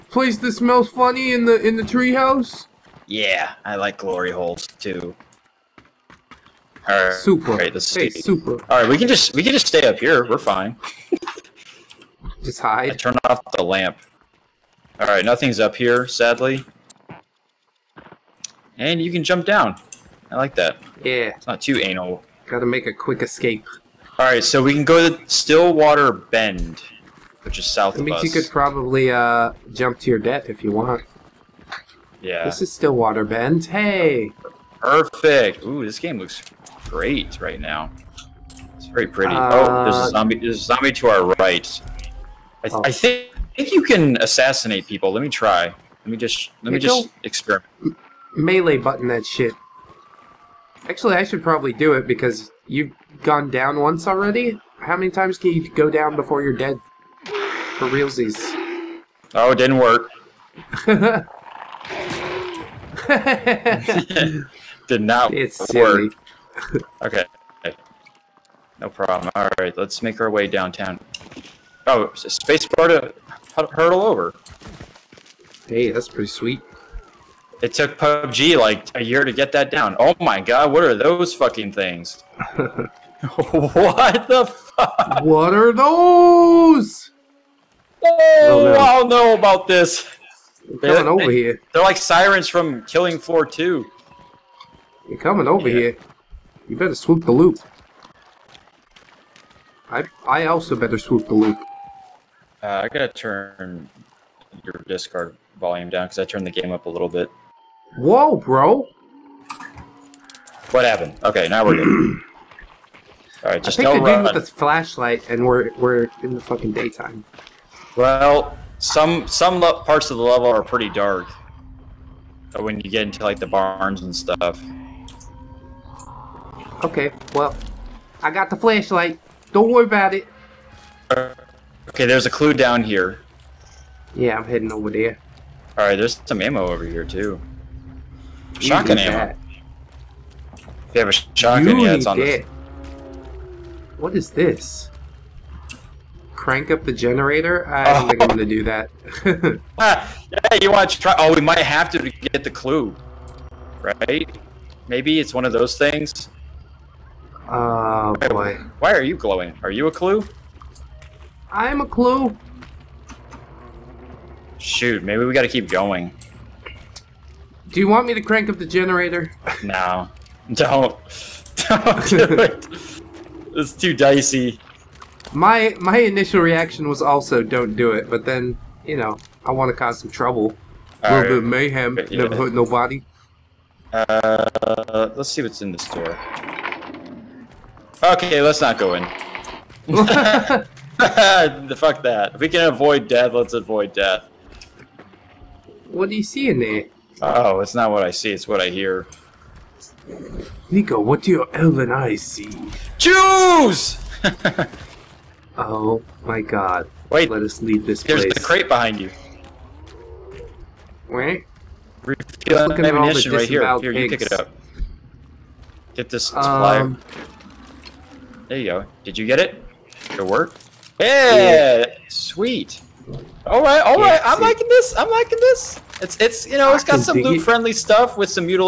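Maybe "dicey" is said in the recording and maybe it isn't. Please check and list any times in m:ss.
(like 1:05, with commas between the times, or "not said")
2:53.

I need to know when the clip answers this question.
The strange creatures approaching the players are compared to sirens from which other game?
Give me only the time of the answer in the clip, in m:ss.
1:32.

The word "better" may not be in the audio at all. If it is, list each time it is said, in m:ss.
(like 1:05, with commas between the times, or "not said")
1:36, 1:40.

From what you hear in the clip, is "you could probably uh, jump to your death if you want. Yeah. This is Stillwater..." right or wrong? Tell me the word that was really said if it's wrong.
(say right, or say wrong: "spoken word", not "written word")
right.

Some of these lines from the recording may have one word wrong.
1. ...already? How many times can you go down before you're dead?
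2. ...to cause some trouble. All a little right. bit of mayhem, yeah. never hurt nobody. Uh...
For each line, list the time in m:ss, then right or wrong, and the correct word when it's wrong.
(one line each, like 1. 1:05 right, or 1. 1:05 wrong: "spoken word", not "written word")
1. 0:54 right
2. 2:59 right.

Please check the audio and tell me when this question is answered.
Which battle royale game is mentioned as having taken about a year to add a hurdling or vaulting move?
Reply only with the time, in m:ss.
1:17.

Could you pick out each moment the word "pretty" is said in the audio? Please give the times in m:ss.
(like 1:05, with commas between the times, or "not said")
0:39, 1:16, 2:00.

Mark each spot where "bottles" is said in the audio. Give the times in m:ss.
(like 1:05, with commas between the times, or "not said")
not said.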